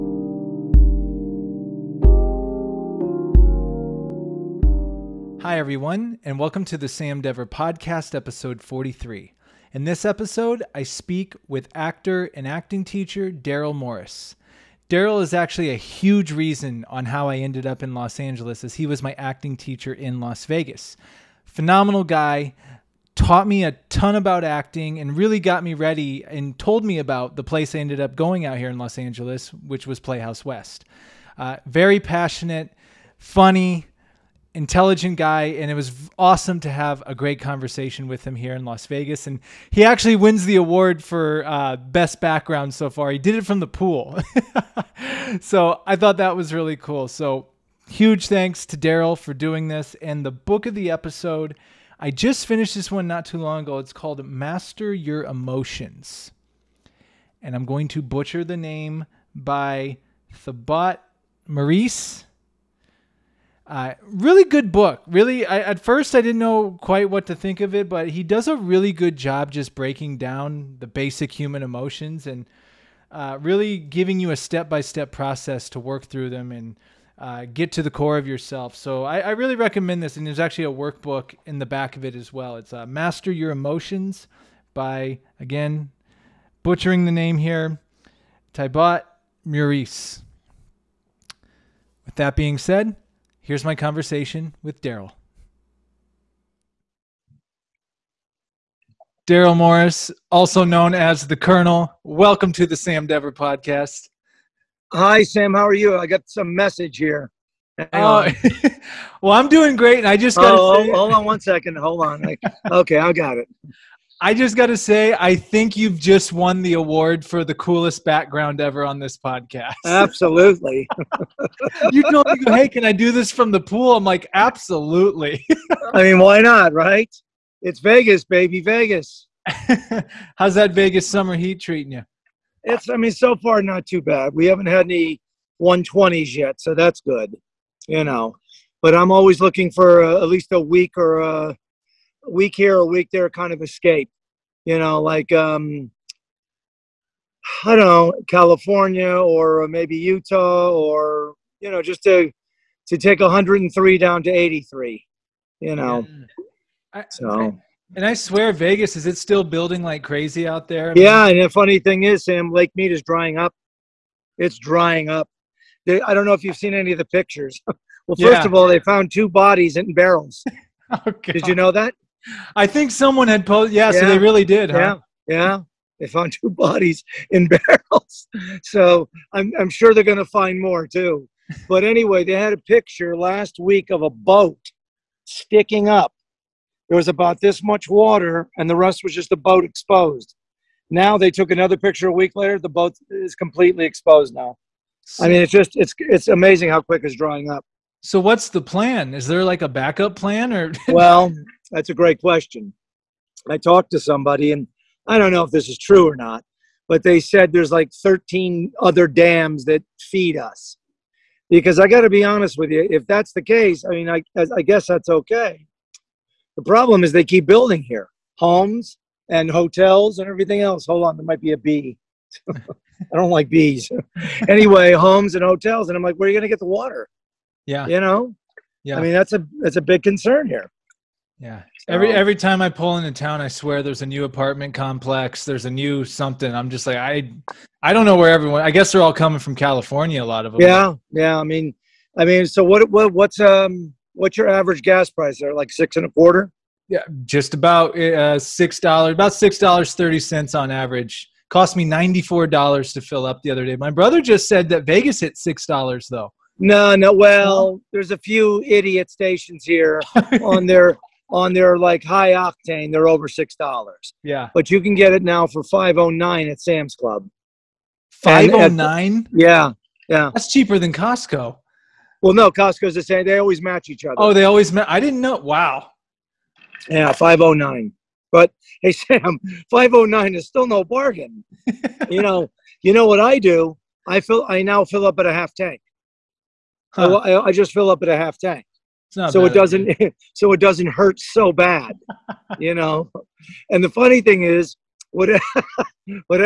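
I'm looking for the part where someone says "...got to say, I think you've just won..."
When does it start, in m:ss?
1:54.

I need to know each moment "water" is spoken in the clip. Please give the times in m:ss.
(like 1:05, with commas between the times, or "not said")
3:07, 3:46.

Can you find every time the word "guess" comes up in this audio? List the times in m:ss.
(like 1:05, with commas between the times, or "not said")
3:34, 3:58.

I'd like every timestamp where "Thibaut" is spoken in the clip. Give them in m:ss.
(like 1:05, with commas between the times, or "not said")
1:00, 1:28.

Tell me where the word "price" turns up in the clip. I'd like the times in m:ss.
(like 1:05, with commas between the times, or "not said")
4:05.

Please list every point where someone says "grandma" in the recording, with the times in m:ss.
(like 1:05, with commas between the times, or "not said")
not said.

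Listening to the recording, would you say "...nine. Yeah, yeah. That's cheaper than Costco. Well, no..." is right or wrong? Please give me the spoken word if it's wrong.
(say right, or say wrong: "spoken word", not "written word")
right.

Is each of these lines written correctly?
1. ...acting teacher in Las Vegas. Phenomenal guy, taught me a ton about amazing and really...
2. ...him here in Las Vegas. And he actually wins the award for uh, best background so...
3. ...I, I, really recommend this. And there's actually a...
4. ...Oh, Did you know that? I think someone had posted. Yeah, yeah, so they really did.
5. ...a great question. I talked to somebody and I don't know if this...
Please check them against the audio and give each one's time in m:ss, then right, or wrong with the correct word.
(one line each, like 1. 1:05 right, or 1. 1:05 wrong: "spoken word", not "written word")
1. 0:19 wrong: "acting", not "amazing"
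2. 0:38 right
3. 1:19 right
4. 2:50 right
5. 3:21 right.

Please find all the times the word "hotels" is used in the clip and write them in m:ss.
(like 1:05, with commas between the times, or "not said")
3:39, 3:45.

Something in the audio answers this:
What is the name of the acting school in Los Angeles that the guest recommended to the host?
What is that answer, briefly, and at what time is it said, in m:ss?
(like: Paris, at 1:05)
Playhouse West, at 0:29.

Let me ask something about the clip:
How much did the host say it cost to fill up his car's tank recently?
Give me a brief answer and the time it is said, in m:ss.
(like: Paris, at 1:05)
$94, at 4:11.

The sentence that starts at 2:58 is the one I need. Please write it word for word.
So I'm, I'm sure they're going to find more too.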